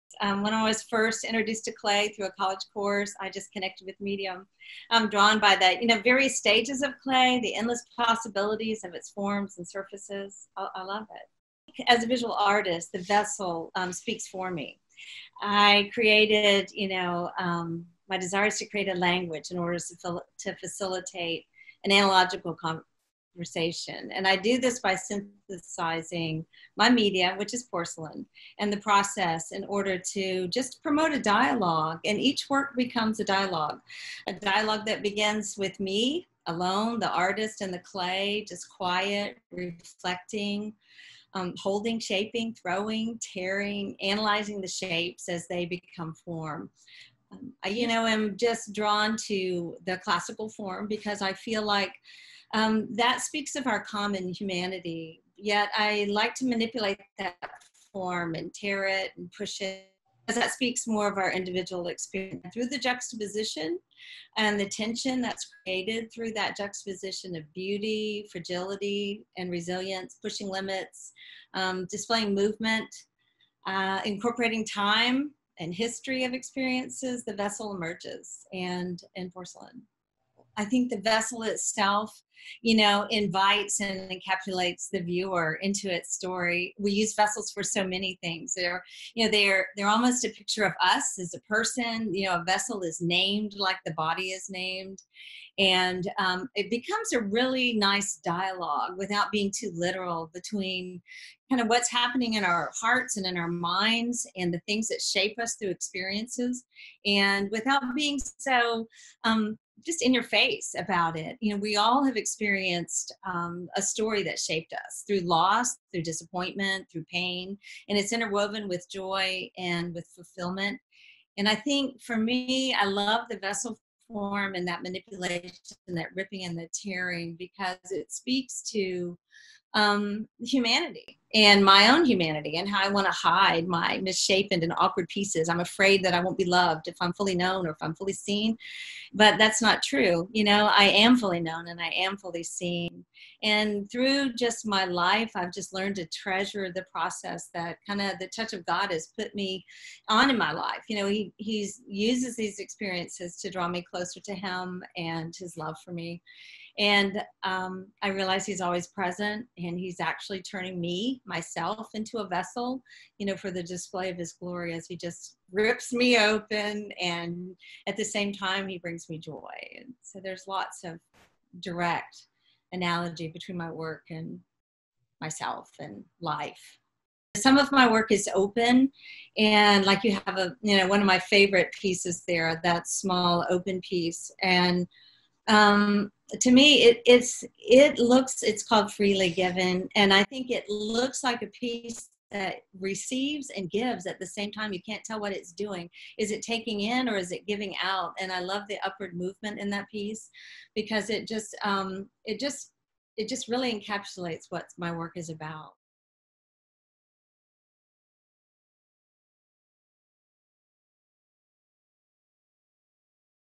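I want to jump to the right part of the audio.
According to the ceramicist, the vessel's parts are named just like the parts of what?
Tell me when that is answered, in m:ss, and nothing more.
1:33.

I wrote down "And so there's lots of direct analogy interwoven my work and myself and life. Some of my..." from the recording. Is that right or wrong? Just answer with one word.
wrong.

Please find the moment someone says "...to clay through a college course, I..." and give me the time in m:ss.
0:01.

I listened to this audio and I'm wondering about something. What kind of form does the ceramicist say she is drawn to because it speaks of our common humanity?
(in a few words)
classical form.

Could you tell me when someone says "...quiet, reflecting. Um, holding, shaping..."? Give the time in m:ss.
0:38.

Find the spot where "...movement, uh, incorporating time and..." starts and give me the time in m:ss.
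1:12.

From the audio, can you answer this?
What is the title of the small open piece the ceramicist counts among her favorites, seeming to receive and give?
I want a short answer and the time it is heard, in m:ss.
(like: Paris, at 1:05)
Freely Given, at 3:08.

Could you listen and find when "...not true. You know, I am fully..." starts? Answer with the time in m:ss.
2:19.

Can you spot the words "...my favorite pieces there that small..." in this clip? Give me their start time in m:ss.
3:01.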